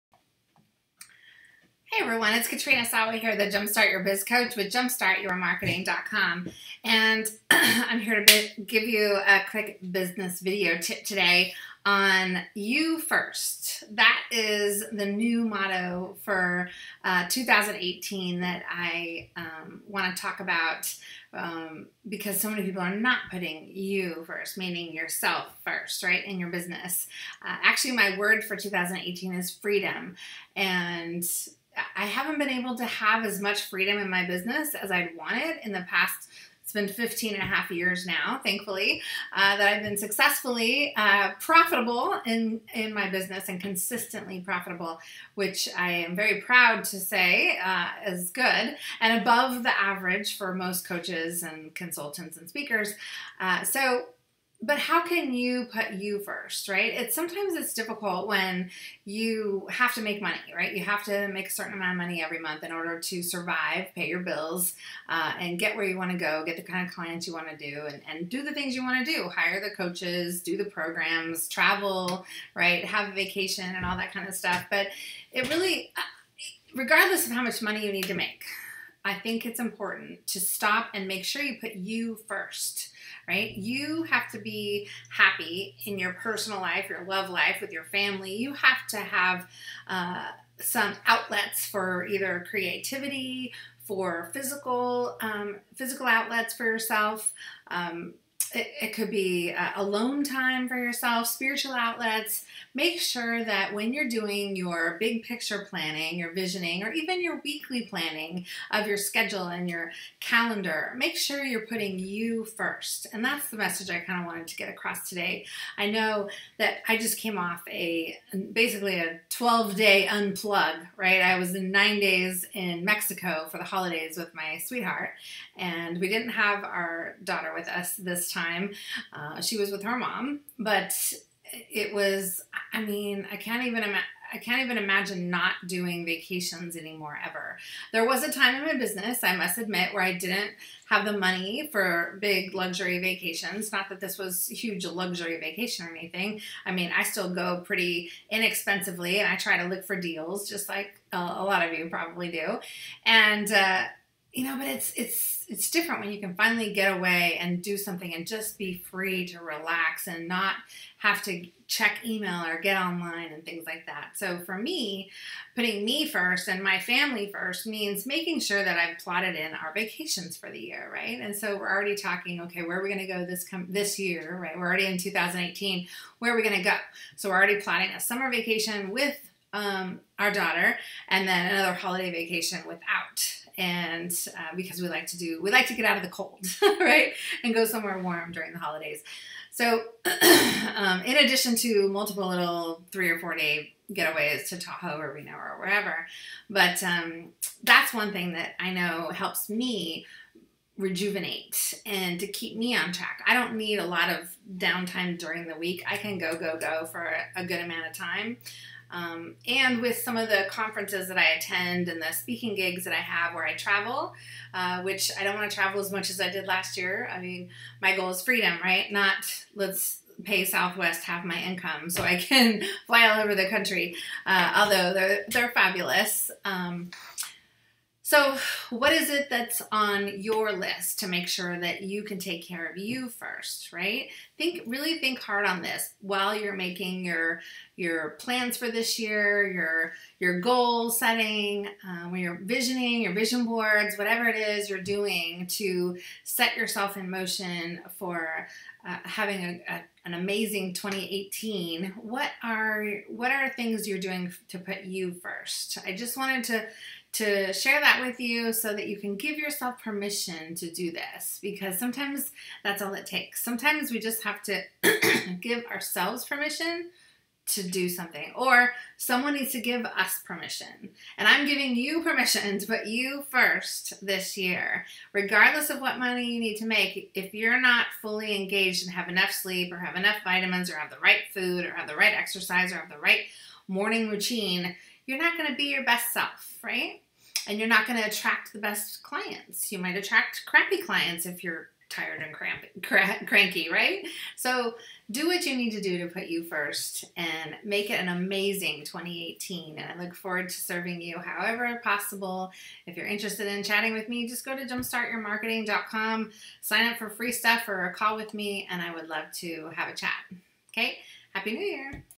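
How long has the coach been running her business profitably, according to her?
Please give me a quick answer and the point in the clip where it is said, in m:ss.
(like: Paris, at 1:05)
15 and a half years, at 0:36.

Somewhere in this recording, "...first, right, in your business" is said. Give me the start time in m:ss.
0:25.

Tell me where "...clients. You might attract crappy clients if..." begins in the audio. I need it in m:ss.
4:49.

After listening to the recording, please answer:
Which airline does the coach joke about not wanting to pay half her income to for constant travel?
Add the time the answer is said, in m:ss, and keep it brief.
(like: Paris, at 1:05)
Southwest, at 3:40.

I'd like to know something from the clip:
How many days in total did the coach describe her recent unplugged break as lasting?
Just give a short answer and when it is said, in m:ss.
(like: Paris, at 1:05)
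12 days, at 1:59.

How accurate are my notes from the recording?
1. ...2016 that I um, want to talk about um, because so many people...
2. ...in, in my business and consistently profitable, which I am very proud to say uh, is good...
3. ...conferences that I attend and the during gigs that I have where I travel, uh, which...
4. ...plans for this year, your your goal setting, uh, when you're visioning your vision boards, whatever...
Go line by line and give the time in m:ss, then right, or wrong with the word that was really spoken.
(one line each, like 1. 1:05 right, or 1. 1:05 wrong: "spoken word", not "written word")
1. 0:17 wrong: "2018", not "2016"
2. 0:42 right
3. 3:30 wrong: "speaking", not "during"
4. 3:58 right.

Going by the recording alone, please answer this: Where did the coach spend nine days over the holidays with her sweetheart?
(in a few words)
Mexico.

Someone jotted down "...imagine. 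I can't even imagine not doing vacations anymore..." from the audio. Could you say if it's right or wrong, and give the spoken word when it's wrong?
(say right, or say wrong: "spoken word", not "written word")
right.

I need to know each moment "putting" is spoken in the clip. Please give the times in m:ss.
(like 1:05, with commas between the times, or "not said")
0:23, 1:51, 2:45.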